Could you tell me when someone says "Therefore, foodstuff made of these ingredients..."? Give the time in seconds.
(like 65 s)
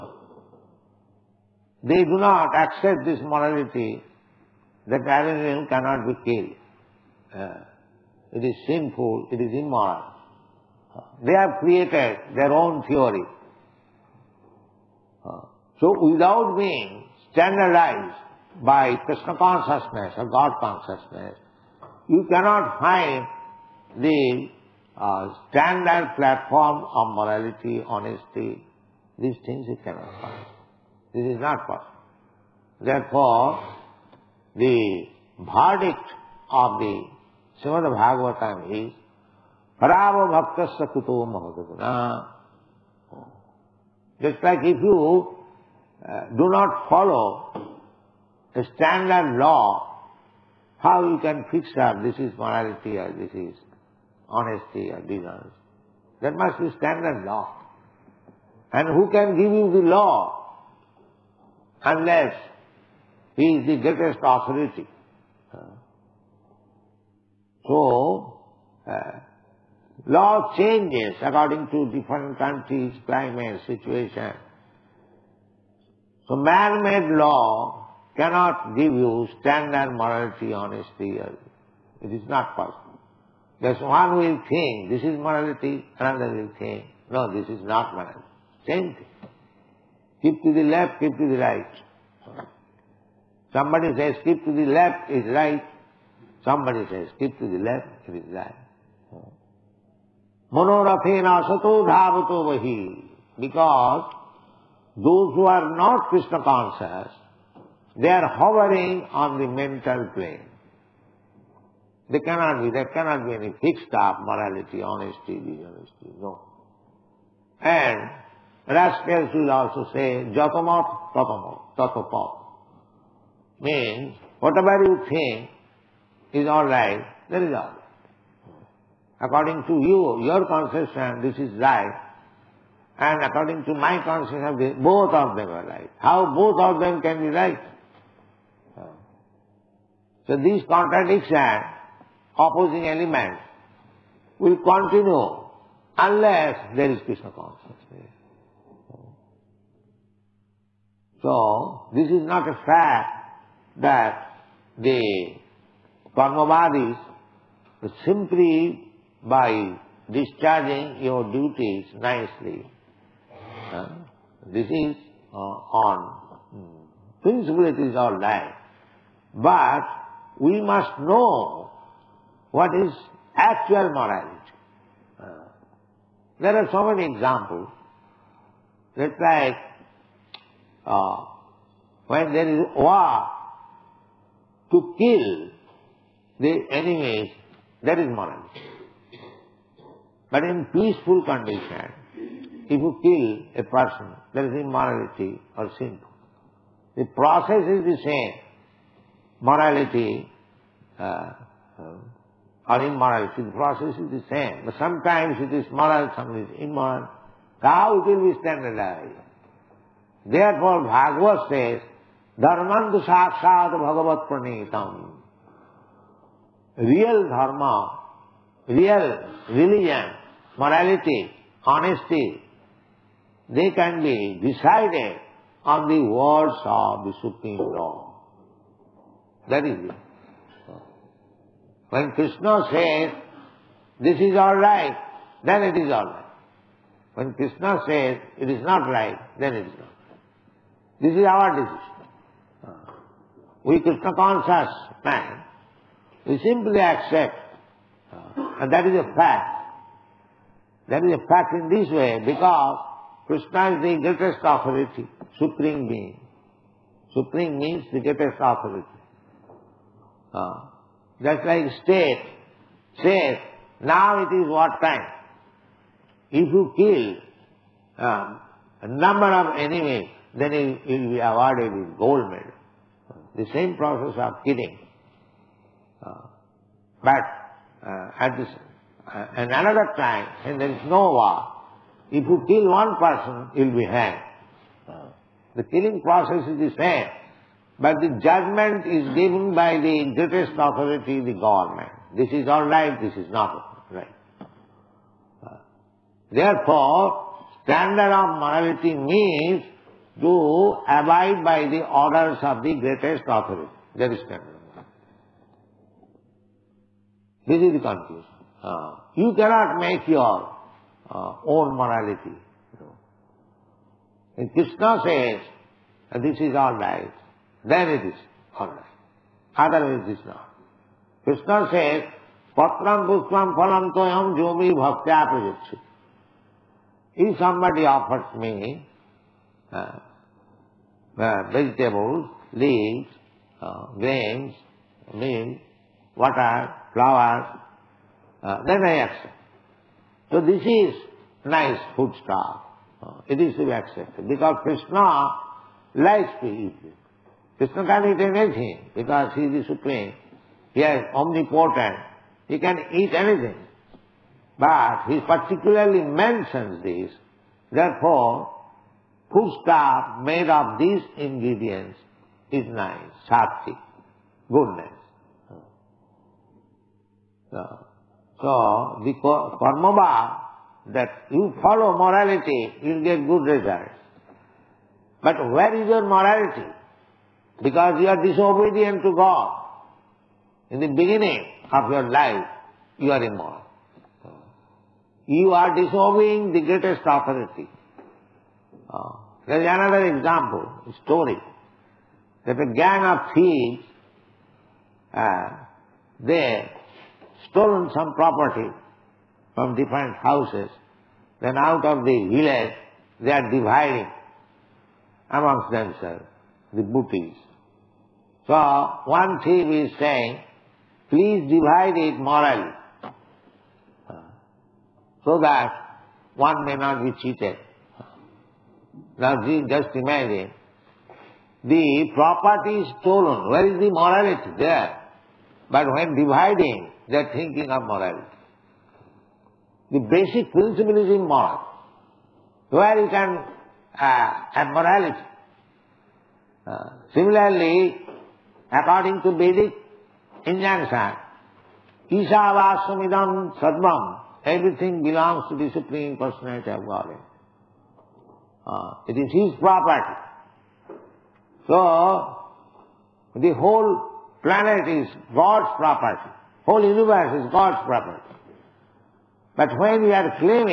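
357 s.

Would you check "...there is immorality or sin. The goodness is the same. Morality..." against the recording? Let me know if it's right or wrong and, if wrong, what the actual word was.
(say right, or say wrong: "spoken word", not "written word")
wrong: "process", not "goodness".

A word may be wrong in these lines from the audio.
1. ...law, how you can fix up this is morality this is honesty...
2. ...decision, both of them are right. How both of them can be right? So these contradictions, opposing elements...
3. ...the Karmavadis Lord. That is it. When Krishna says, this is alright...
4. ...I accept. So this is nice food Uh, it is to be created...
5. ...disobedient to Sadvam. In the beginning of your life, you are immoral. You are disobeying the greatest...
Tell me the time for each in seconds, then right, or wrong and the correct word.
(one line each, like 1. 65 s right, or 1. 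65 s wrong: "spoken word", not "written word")
1. 49 s right
2. 134 s wrong: "conception", not "decision"
3. 227 s wrong: "Supreme", not "Karmavadis"
4. 338 s wrong: "accepted", not "created"
5. 378 s wrong: "God", not "Sadvam".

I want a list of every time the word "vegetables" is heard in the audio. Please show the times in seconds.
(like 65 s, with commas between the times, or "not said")
331 s.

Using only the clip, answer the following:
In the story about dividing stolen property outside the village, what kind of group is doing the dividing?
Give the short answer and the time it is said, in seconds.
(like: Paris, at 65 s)
A gang of thieves, at 392 s.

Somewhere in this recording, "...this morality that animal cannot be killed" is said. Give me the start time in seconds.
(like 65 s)
3 s.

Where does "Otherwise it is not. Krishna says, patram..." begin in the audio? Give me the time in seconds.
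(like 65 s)
319 s.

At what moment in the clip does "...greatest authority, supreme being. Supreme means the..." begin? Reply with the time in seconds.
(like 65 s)
254 s.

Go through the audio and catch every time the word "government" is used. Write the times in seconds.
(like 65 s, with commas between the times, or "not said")
291 s.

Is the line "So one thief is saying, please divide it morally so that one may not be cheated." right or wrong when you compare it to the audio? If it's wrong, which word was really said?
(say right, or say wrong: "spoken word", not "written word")
right.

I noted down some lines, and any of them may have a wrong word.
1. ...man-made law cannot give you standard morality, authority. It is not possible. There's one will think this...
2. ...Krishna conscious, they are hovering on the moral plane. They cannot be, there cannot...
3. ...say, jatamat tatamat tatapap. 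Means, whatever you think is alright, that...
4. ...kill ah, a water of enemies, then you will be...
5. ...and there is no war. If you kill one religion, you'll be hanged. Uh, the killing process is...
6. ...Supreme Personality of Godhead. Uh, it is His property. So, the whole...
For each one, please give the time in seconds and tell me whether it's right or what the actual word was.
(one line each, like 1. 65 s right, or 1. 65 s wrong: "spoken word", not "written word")
1. 76 s wrong: "honesty", not "authority"
2. 106 s wrong: "mental", not "moral"
3. 119 s right
4. 266 s wrong: "number", not "water"
5. 280 s wrong: "person", not "religion"
6. 445 s right.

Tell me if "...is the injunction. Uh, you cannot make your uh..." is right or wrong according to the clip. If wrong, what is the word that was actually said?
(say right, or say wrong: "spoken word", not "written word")
wrong: "conclusion", not "injunction".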